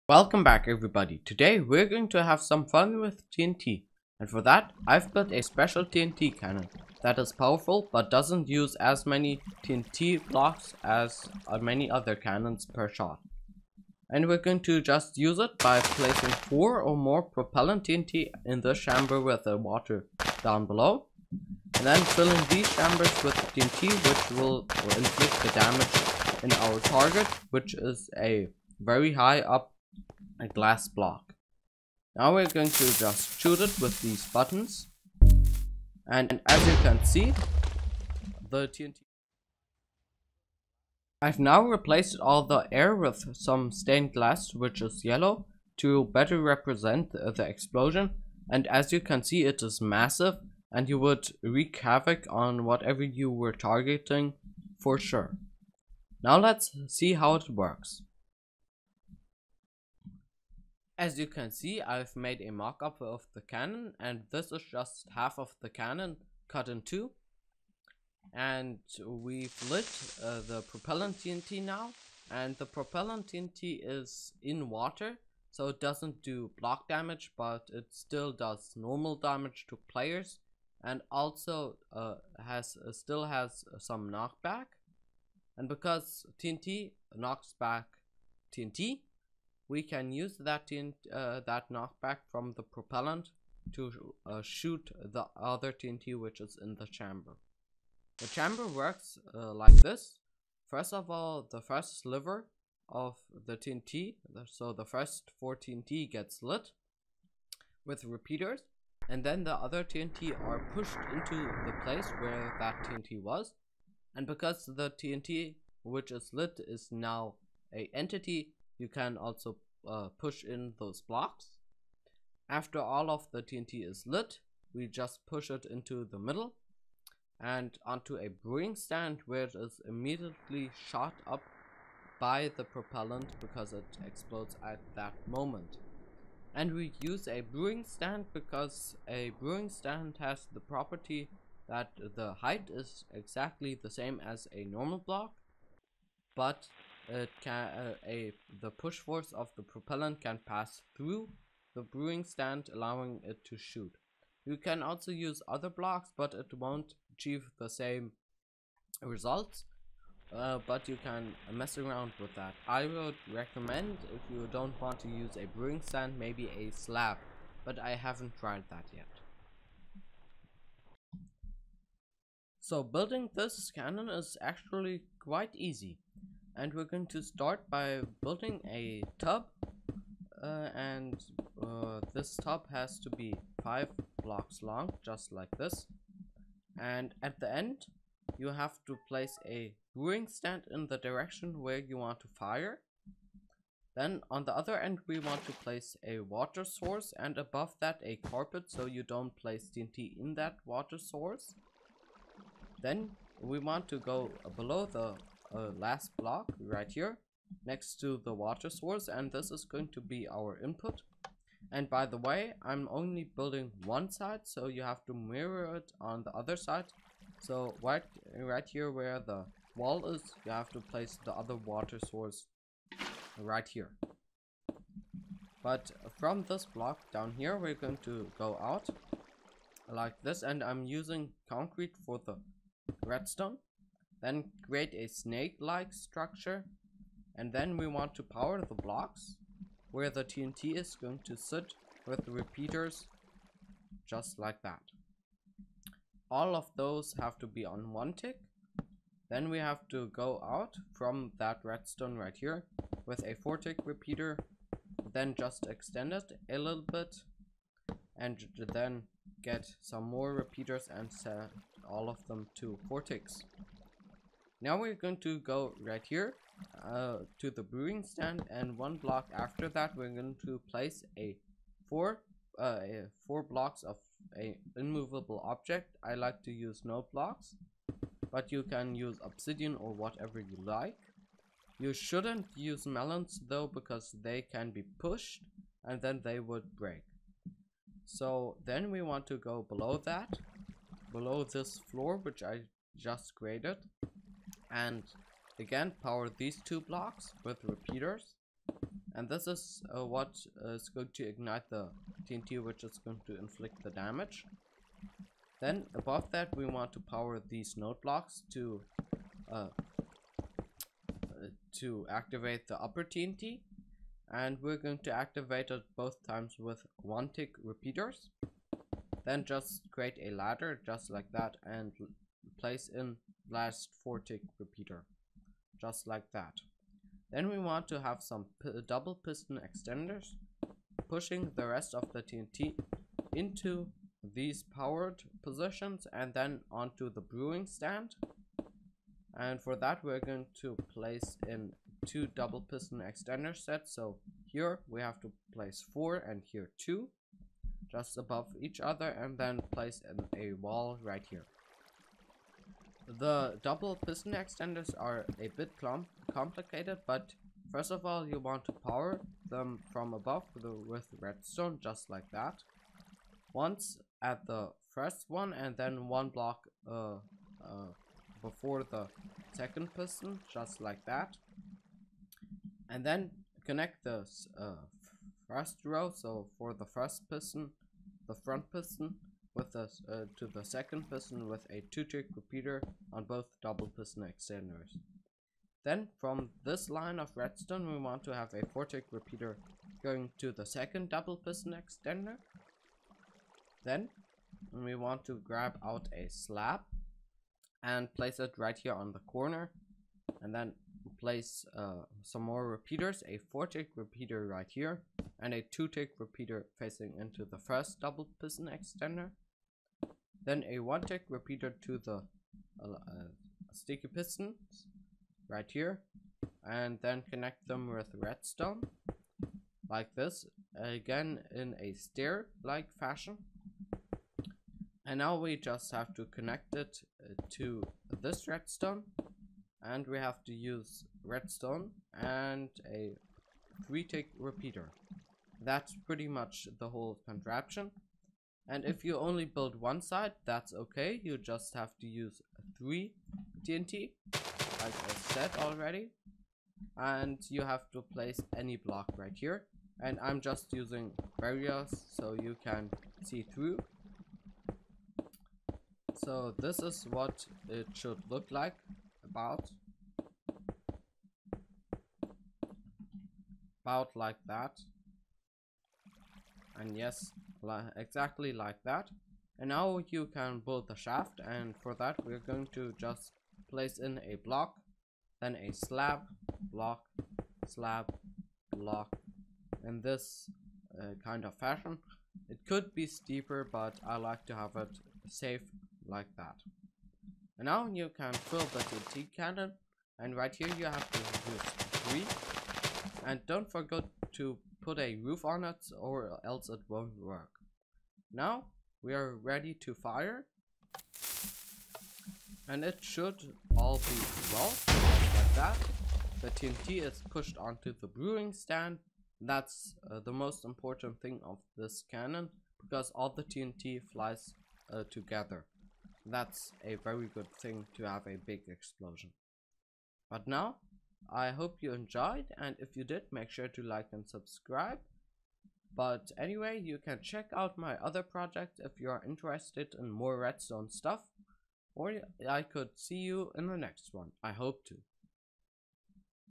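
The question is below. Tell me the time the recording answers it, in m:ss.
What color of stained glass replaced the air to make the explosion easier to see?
0:45.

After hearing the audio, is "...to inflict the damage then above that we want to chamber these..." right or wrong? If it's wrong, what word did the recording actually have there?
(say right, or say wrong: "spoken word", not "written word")
wrong: "power", not "chamber".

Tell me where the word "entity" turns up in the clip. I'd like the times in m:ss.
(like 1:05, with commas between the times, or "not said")
1:57.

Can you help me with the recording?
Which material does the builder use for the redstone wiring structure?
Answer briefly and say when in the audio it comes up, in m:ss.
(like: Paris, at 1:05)
Concrete, at 3:51.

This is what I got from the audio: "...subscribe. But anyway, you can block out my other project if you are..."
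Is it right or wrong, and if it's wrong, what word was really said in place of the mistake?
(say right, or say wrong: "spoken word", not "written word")
wrong: "check", not "block".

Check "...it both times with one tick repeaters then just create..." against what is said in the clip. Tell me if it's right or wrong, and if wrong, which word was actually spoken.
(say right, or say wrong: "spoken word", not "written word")
right.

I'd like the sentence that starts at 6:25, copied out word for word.
Then from this line of redstone we want to have a four-tick repeater going to the second double piston extender.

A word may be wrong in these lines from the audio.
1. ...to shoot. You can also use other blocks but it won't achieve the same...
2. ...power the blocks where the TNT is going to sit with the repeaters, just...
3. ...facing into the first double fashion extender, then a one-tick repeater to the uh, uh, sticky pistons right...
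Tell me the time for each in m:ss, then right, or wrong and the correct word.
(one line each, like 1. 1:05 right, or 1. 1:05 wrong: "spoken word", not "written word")
1. 2:33 right
2. 3:58 right
3. 6:46 wrong: "piston", not "fashion".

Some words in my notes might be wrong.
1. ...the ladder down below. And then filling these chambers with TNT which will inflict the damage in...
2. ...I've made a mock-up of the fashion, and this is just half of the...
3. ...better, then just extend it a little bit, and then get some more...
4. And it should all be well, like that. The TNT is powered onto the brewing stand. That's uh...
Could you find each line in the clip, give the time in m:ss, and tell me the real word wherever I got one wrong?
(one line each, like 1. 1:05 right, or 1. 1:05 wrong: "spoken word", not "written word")
1. 0:19 wrong: "water", not "ladder"
2. 1:01 wrong: "cannon", not "fashion"
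3. 4:13 wrong: "repeater", not "better"
4. 8:22 wrong: "pushed", not "powered".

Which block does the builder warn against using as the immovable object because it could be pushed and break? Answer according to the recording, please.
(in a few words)
Melons.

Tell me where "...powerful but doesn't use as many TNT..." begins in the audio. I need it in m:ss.
0:07.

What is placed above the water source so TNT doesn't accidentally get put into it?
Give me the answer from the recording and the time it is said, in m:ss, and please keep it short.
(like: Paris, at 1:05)
A carpet, at 3:18.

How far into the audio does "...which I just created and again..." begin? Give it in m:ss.
4:52.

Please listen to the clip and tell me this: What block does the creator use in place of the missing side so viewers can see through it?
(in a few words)
Barriers.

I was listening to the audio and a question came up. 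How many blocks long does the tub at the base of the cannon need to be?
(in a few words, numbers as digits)
5.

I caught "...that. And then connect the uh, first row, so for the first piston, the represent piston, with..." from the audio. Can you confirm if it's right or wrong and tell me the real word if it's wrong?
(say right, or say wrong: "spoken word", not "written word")
wrong: "front", not "represent".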